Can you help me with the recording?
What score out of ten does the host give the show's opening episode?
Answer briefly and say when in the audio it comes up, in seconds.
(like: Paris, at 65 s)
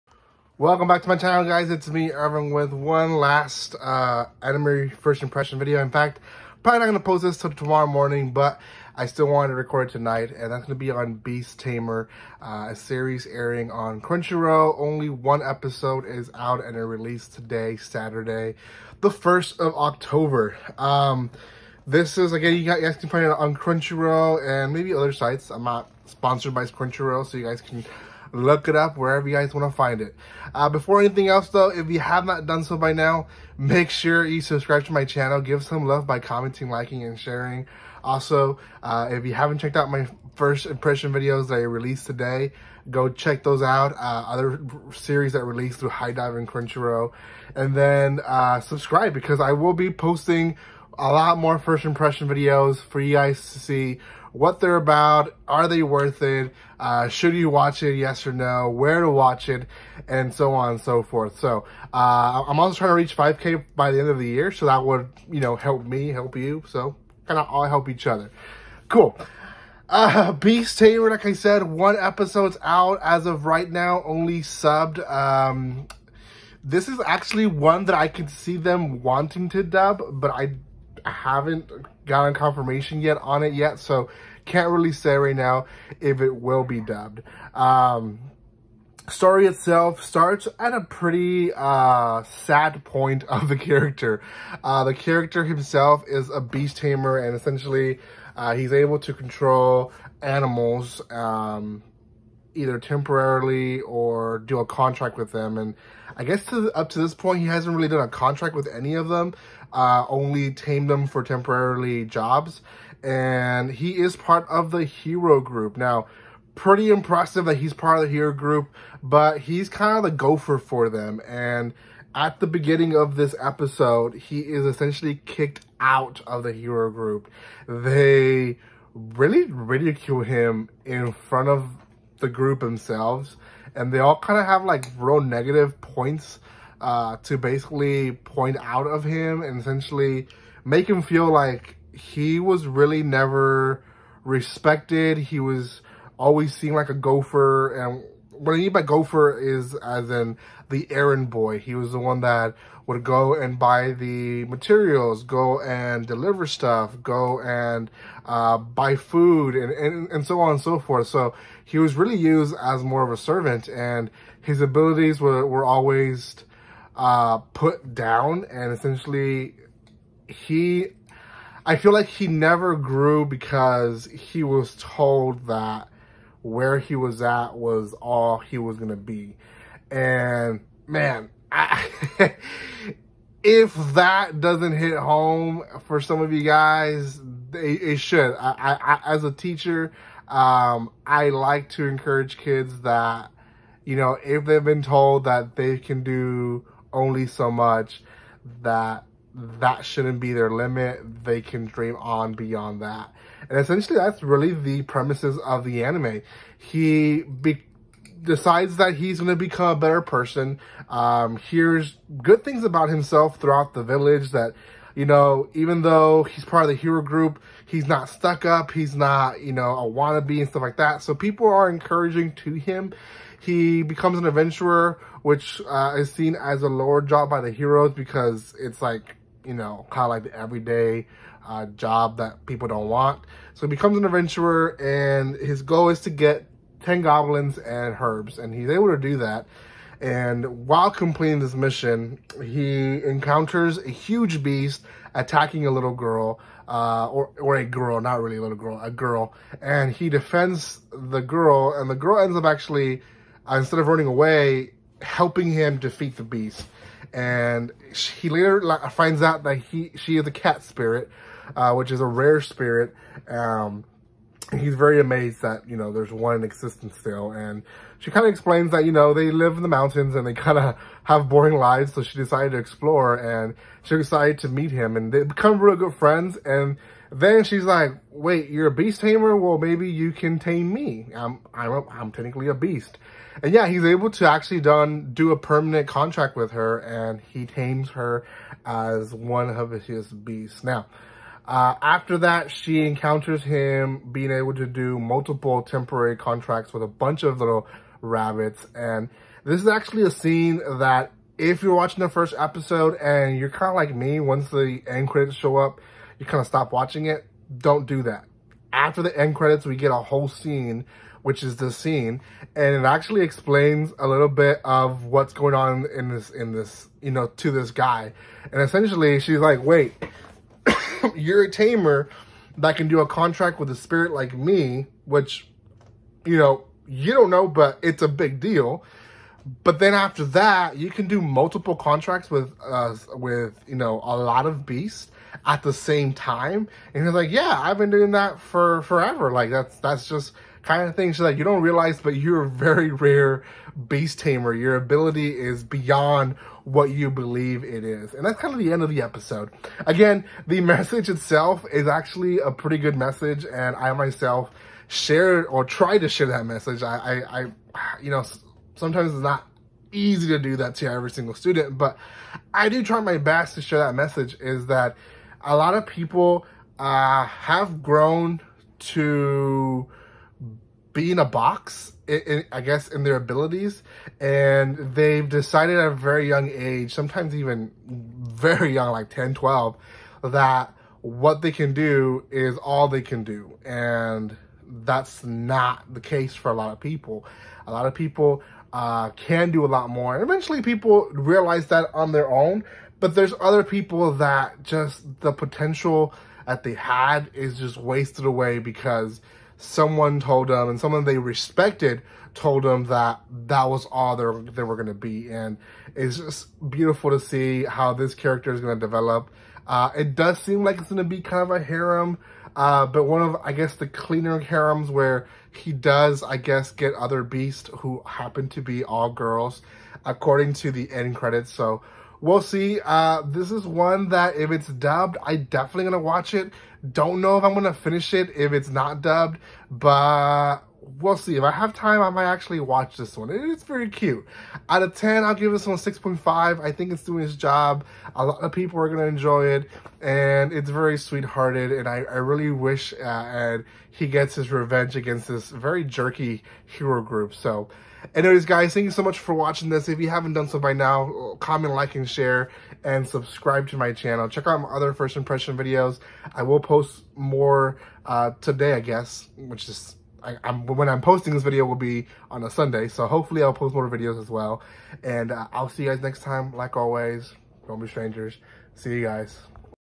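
6.5, at 435 s.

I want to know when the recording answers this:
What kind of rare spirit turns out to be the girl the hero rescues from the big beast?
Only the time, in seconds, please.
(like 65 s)
260 s.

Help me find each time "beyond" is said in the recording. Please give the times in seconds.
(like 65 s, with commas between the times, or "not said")
202 s, 345 s.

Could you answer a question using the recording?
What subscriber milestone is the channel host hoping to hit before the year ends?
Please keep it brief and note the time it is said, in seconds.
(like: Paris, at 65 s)
5K, at 63 s.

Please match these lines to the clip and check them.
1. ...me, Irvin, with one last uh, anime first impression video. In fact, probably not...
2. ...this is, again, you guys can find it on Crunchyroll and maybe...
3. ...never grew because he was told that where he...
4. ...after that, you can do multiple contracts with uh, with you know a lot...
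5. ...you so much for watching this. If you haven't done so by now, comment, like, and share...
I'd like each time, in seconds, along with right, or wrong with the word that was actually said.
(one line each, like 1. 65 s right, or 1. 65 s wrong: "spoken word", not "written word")
1. 1 s right
2. 21 s right
3. 172 s right
4. 329 s right
5. 448 s right.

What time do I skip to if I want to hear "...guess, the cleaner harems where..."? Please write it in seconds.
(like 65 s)
413 s.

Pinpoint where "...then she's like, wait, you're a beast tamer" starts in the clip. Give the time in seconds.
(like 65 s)
277 s.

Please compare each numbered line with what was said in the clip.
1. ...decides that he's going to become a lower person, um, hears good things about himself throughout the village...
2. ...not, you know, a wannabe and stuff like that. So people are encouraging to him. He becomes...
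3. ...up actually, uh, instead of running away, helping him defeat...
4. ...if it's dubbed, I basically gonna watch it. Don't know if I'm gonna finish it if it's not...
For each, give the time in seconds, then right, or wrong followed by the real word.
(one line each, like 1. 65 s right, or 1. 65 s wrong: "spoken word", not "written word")
1. 208 s wrong: "better", not "lower"
2. 218 s right
3. 252 s right
4. 424 s wrong: "definitely", not "basically".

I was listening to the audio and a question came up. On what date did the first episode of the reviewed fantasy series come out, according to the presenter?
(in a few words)
Saturday, 1st of October.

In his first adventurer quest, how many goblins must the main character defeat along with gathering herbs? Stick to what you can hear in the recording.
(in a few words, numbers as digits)
10.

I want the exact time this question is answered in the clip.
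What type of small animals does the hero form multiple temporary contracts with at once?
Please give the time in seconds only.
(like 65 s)
297 s.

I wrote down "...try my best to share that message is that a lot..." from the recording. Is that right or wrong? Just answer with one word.
right.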